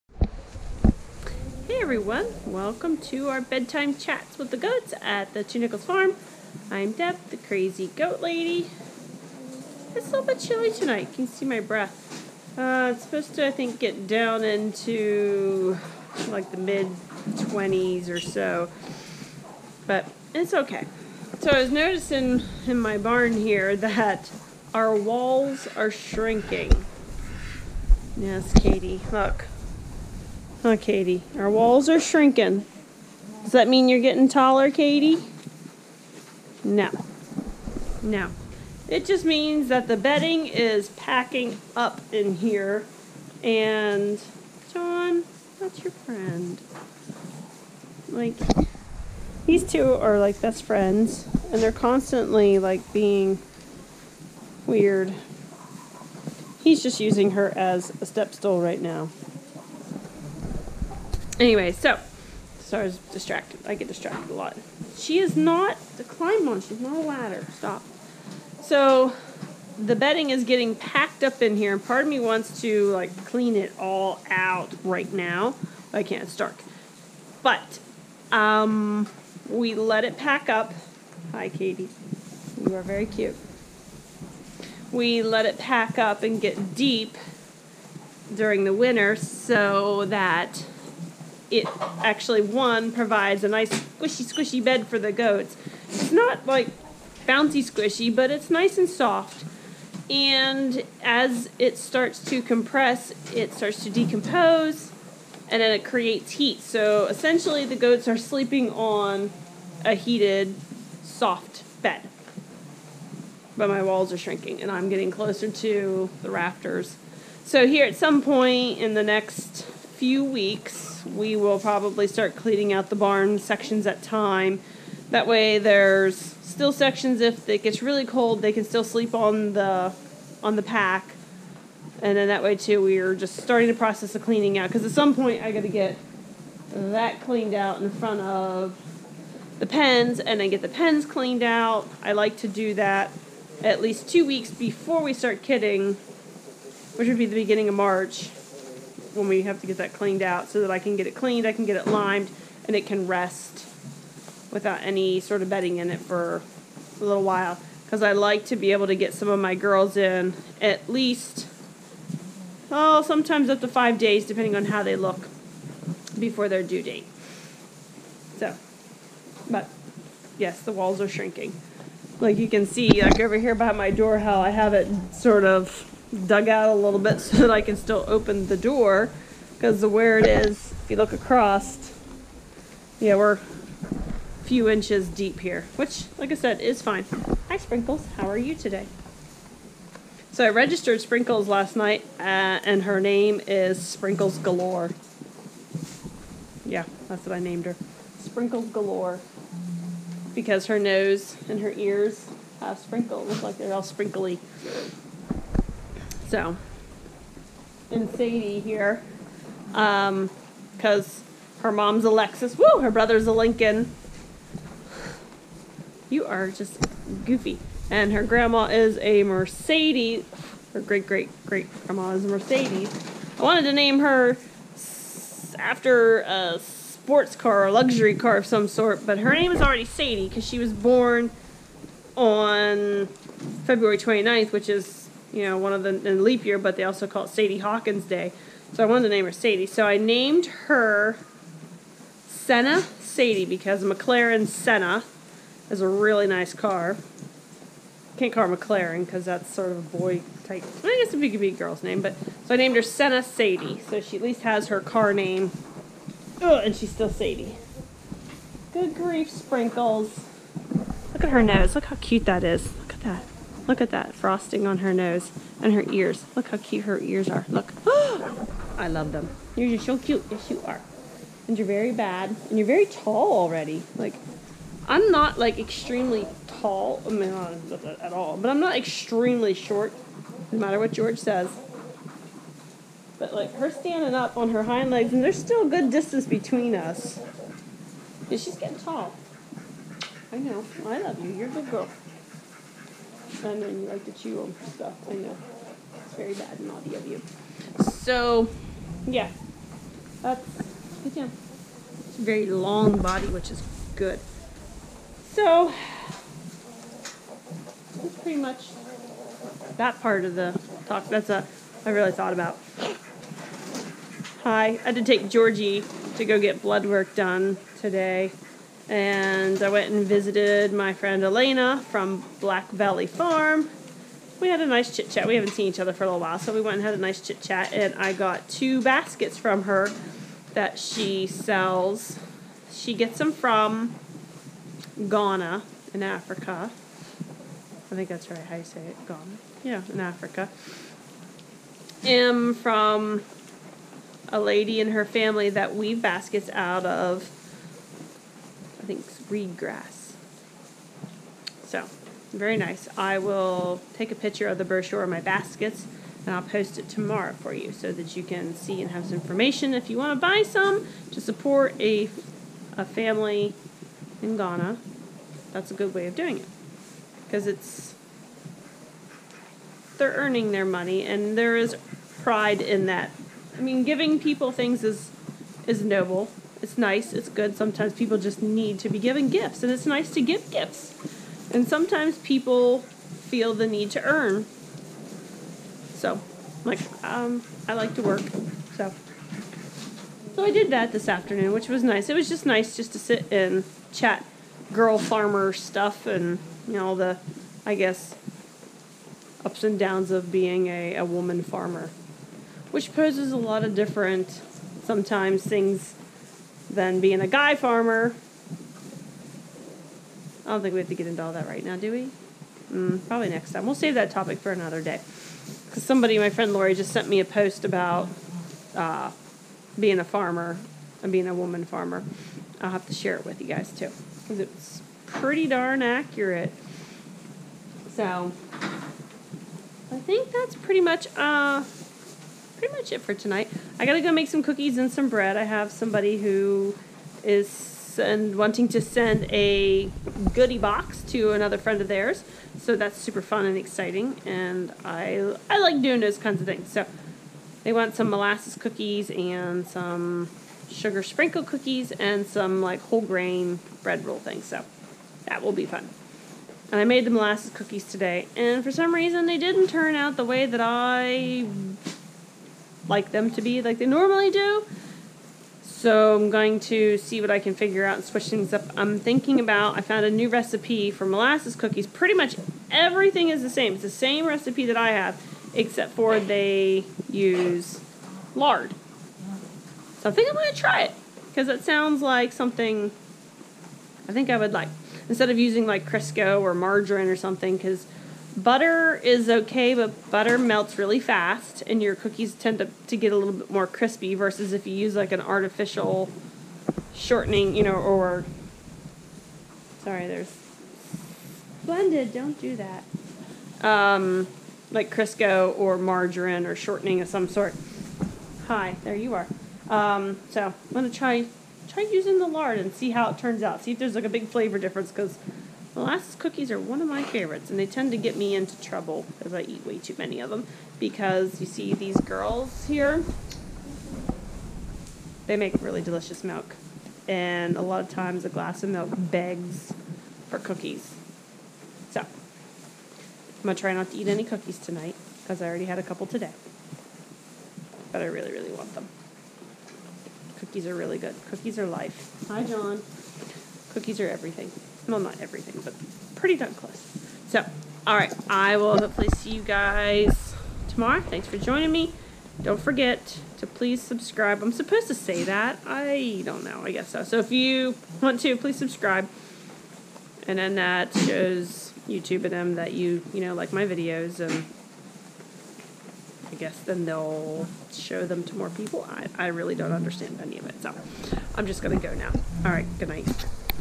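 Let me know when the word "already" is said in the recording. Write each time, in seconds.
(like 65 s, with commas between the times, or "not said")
229 s, 273 s, 535 s.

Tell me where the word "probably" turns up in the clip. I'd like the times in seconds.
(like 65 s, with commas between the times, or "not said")
121 s, 413 s.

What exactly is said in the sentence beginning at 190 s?
So I registered Sprinkles last night, uh, and her name is Sprinkles Galore.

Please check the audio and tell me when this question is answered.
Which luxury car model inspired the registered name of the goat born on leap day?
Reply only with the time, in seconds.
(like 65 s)
243 s.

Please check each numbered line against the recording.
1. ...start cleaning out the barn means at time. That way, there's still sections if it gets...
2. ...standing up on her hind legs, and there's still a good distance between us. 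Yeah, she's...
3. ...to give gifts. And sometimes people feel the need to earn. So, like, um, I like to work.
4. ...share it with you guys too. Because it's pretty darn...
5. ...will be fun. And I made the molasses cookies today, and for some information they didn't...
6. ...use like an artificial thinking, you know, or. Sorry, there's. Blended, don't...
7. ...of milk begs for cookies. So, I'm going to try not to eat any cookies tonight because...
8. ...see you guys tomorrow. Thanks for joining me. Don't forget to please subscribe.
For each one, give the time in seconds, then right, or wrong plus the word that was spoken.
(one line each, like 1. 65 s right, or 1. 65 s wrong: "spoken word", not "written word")
1. 122 s wrong: "sections", not "means"
2. 283 s right
3. 380 s right
4. 422 s right
5. 455 s wrong: "reason", not "information"
6. 494 s wrong: "shortening", not "thinking"
7. 528 s right
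8. 549 s right.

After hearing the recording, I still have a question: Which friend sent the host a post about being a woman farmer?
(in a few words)
Lori.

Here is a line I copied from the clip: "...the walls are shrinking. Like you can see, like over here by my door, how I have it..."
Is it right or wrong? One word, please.
right.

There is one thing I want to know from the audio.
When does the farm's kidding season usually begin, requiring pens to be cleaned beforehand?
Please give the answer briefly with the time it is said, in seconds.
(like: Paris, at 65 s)
beginning of March, at 147 s.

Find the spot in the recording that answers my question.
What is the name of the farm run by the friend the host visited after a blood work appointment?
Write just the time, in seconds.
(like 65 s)
322 s.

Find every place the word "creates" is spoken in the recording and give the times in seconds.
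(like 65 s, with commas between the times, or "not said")
105 s.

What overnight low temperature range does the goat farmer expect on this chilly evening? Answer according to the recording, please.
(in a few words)
mid 20s.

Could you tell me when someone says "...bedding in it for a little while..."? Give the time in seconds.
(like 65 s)
155 s.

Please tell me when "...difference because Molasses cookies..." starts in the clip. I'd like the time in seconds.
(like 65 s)
514 s.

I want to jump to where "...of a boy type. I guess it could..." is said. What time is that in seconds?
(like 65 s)
249 s.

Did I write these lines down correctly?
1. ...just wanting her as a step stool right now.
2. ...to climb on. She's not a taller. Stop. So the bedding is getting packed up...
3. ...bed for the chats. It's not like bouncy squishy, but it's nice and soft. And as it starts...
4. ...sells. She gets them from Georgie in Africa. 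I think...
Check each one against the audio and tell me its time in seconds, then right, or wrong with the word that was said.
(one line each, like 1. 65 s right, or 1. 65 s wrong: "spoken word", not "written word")
1. 56 s wrong: "using", not "wanting"
2. 65 s wrong: "ladder", not "taller"
3. 94 s wrong: "goats", not "chats"
4. 331 s wrong: "Ghana", not "Georgie".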